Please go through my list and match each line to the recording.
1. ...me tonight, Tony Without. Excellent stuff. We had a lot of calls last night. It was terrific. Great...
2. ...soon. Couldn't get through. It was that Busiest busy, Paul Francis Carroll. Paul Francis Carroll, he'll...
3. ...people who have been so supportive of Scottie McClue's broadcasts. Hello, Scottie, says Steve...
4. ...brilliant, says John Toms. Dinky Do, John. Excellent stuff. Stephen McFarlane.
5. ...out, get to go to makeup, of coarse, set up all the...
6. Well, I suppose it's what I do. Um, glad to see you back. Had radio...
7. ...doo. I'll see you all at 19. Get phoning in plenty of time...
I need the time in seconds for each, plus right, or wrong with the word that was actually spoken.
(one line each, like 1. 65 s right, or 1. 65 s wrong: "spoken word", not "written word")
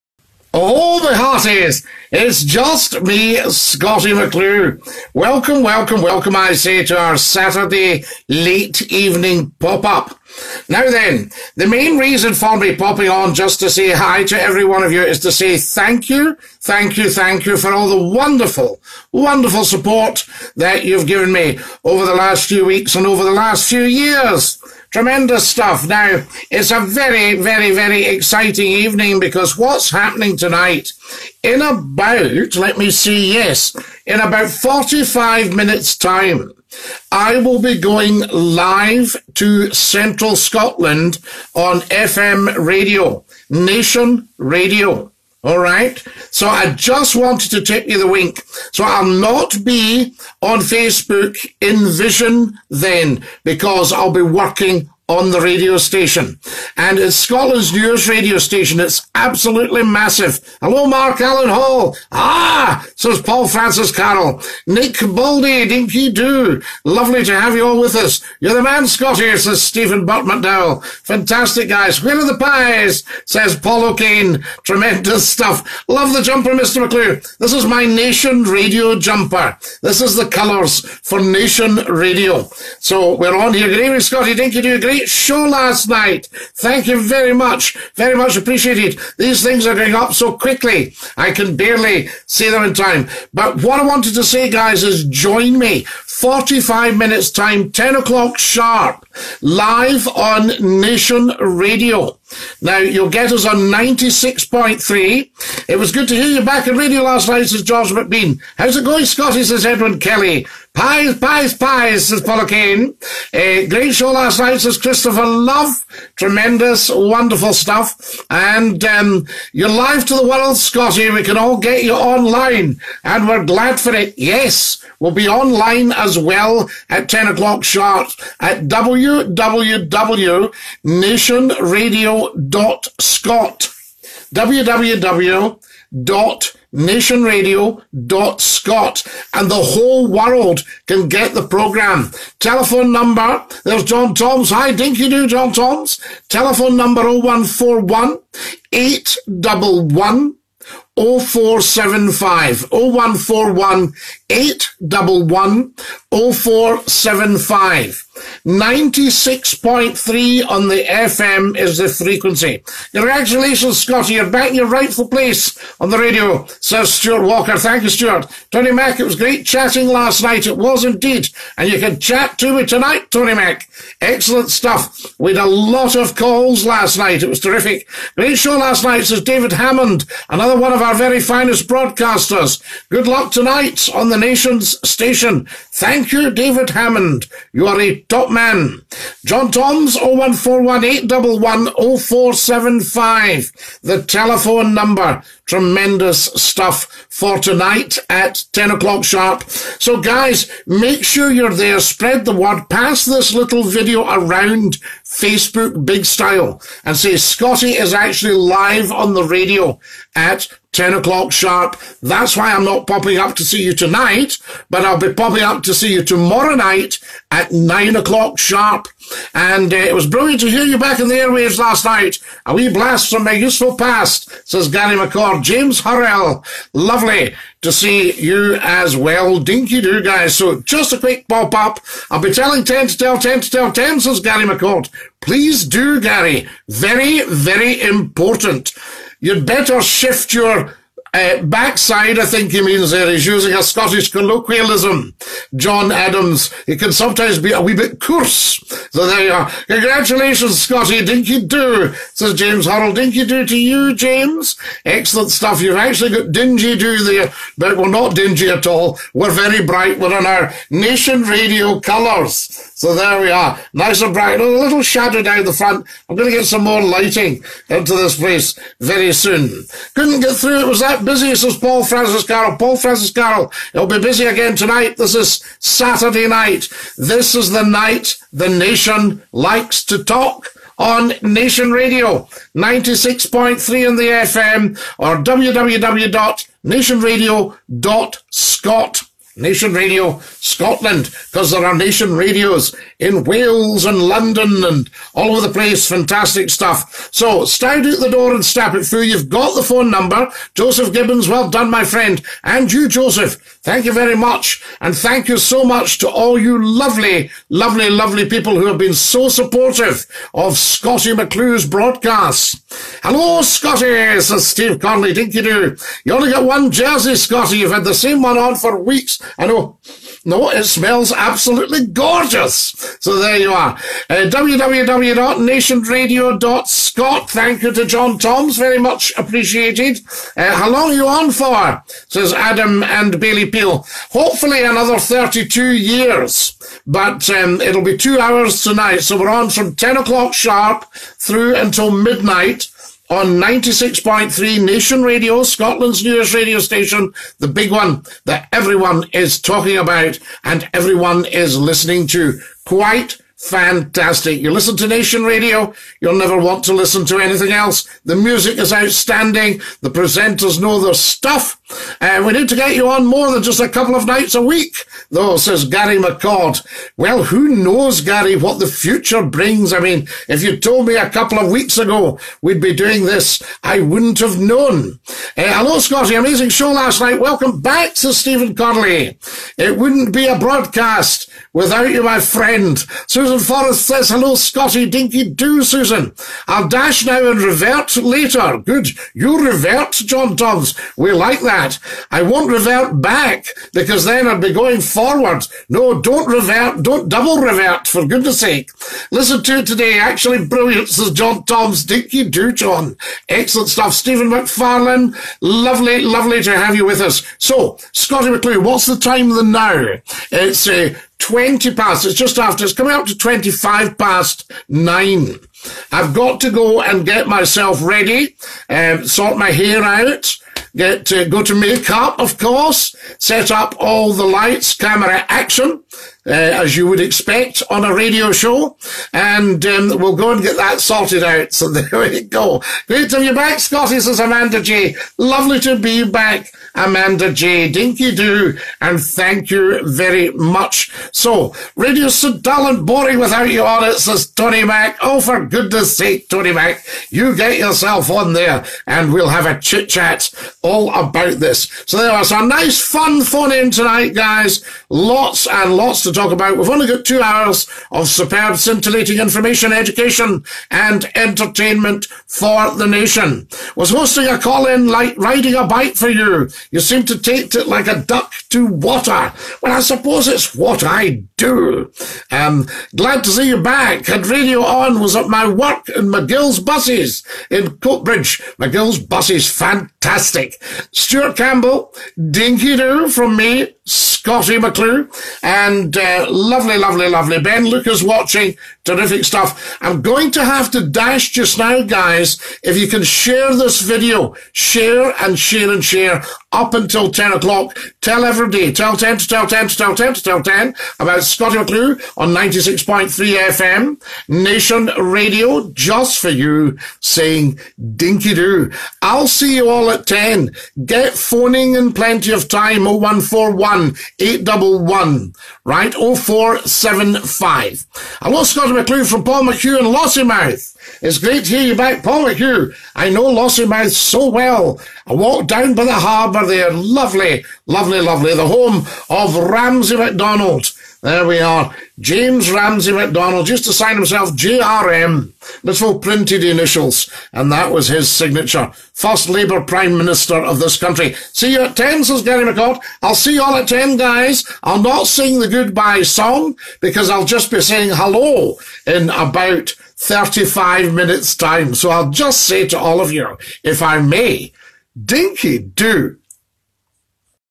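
1. 172 s wrong: "Mack", not "Without"
2. 269 s right
3. 308 s right
4. 400 s right
5. 419 s wrong: "course", not "coarse"
6. 469 s right
7. 508 s wrong: "10", not "19".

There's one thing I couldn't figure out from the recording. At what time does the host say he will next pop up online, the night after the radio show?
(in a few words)
9 o'clock.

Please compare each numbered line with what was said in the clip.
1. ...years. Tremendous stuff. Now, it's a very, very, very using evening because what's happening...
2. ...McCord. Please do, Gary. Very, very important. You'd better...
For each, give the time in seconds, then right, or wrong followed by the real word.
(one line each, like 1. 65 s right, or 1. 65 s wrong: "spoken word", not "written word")
1. 23 s wrong: "exciting", not "using"
2. 234 s right.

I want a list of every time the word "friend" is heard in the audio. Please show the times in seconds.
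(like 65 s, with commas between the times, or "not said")
301 s, 382 s.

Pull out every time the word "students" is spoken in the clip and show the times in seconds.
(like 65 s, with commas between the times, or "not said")
not said.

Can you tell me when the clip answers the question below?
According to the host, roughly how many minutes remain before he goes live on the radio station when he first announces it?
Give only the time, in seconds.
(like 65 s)
34 s.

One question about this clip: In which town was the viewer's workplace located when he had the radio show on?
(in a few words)
Coatbridge.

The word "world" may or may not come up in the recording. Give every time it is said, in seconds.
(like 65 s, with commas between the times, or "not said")
120 s, 140 s.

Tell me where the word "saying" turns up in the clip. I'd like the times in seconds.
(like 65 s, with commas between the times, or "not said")
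506 s, 547 s.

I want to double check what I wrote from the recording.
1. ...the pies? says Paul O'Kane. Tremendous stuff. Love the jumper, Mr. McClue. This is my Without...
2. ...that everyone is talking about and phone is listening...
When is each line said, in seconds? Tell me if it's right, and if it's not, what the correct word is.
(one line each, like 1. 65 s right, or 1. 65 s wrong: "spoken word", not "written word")
1. 72 s wrong: "Nation", not "Without"
2. 348 s wrong: "everyone", not "phone".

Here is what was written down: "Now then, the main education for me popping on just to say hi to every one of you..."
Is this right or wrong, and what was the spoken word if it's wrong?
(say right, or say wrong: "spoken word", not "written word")
wrong: "reason", not "education".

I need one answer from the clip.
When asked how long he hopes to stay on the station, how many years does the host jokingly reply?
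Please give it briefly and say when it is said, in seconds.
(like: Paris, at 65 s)
32, at 334 s.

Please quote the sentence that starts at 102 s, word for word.
Now, you'll get us on 96.3.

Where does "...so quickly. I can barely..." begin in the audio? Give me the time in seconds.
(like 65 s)
90 s.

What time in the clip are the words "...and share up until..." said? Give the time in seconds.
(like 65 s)
495 s.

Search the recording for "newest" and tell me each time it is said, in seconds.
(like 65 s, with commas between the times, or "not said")
57 s, 346 s.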